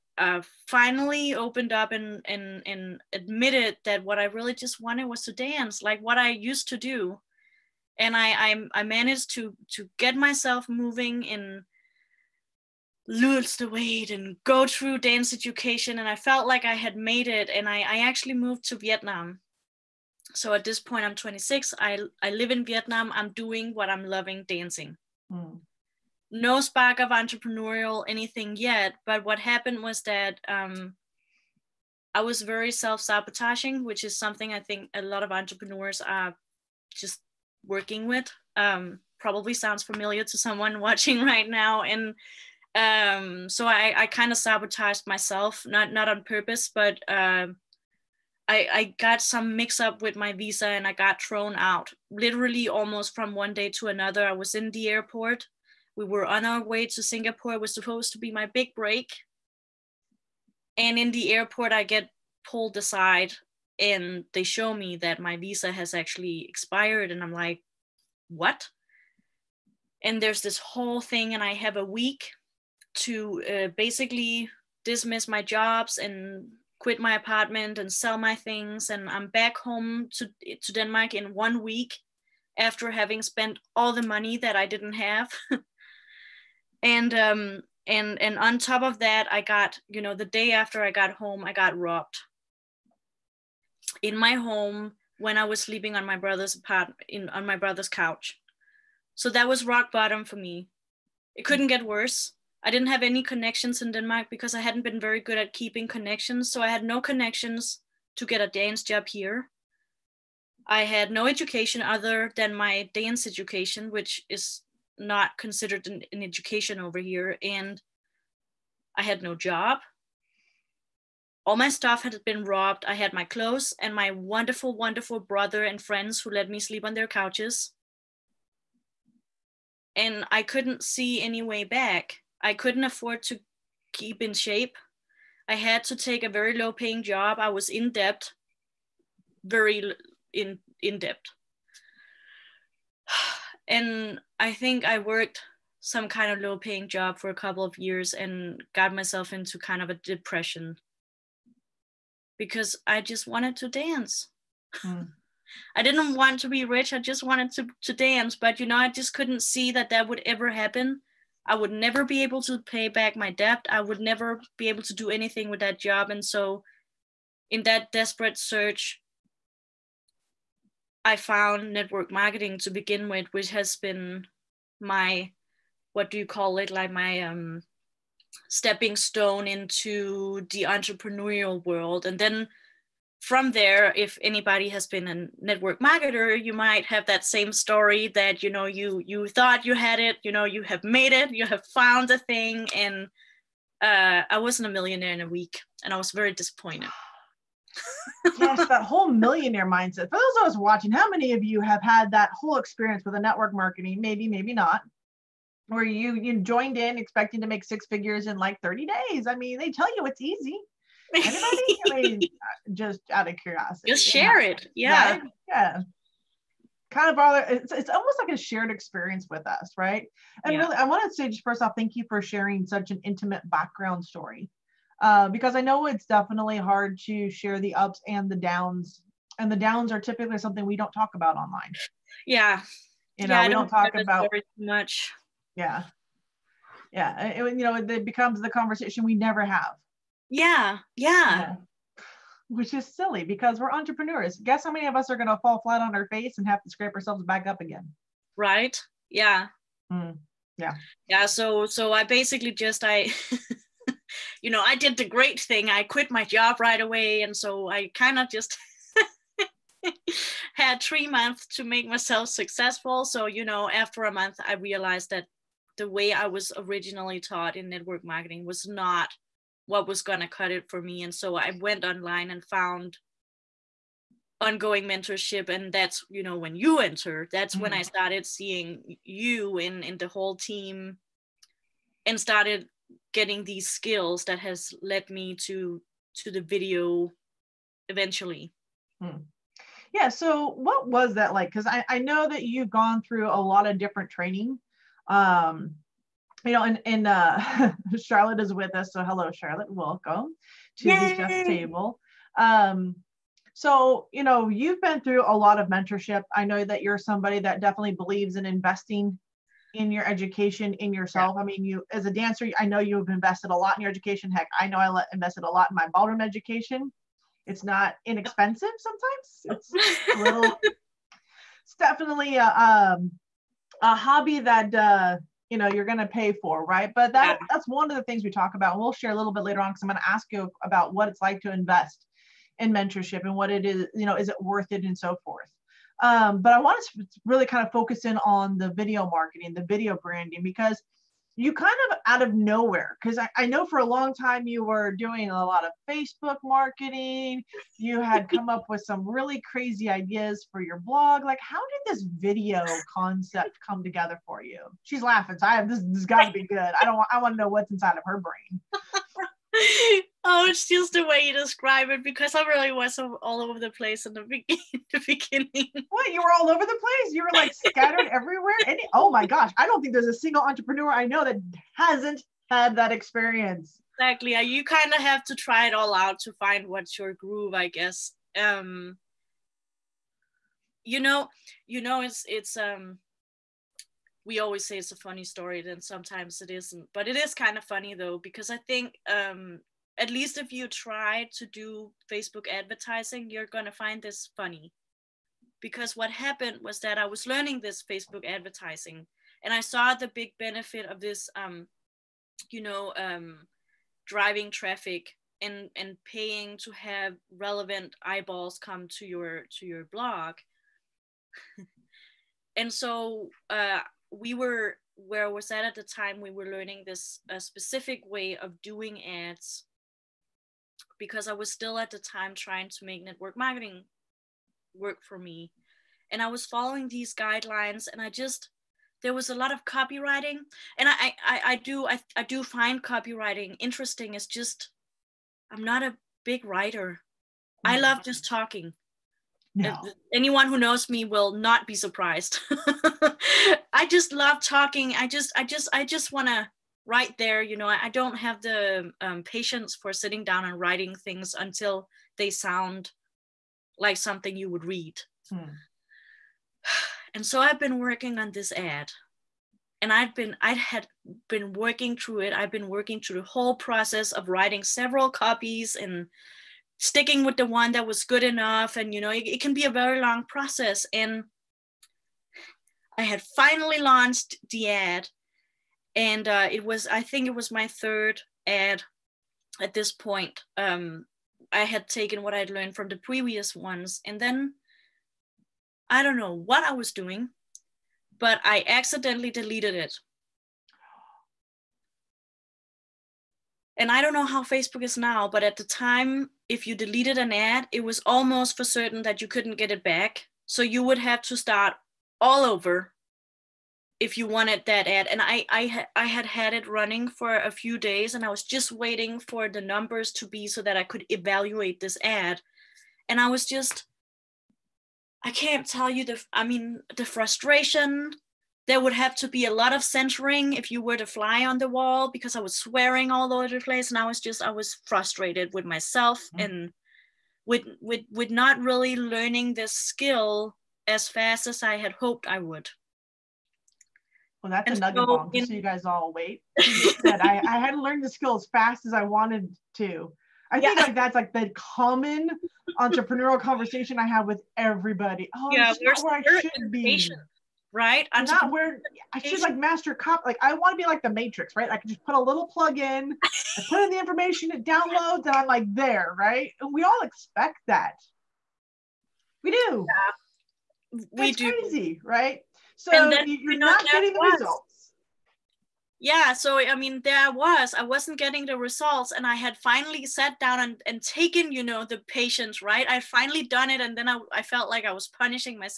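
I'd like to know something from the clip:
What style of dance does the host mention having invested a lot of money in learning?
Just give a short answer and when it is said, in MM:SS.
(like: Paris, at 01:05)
Ballroom, at 05:15.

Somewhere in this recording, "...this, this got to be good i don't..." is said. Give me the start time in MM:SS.
05:55.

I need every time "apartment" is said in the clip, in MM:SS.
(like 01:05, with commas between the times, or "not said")
01:17, 01:36.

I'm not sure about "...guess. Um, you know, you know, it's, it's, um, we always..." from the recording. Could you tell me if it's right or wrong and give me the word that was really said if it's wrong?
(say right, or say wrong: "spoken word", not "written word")
right.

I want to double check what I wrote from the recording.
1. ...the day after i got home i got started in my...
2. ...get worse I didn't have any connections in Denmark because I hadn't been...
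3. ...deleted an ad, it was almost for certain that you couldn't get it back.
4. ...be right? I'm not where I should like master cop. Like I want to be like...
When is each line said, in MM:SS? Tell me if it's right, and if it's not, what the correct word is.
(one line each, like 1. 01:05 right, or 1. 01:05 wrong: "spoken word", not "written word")
1. 01:30 wrong: "robbed", not "started"
2. 01:41 right
3. 08:16 right
4. 09:06 right.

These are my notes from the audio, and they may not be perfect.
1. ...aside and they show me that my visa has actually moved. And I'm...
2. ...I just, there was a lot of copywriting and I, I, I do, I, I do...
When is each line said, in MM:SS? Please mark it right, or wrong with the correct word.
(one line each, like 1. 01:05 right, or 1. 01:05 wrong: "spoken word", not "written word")
1. 01:02 wrong: "expired", not "moved"
2. 07:08 right.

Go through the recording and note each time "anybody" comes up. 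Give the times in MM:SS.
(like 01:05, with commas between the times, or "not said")
03:04, 03:31.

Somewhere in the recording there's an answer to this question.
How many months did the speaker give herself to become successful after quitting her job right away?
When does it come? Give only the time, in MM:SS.
04:20.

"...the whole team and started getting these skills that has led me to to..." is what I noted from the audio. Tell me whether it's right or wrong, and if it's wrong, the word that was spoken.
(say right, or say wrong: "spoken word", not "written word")
right.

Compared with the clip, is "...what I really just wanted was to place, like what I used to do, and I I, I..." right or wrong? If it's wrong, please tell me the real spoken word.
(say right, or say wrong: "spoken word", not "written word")
wrong: "dance", not "place".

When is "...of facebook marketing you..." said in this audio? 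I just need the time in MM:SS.
05:45.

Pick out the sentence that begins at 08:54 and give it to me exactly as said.
Well, that's and a nugget so bomb, in- so you guys all wait.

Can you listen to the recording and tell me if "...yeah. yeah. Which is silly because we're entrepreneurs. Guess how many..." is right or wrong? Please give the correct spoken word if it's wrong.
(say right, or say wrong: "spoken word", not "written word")
right.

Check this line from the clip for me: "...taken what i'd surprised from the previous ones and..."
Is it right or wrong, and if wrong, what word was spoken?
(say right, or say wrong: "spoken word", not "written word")
wrong: "learned", not "surprised".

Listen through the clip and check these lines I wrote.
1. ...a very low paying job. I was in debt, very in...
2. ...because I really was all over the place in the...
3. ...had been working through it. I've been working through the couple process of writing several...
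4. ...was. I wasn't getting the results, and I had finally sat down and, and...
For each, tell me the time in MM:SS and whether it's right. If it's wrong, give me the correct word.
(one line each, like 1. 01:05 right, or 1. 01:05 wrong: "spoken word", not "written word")
1. 02:16 right
2. 06:02 right
3. 07:40 wrong: "whole", not "couple"
4. 09:27 right.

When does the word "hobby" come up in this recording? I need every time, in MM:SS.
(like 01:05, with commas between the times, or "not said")
05:23.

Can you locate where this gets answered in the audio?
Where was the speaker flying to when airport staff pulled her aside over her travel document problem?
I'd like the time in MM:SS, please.
00:55.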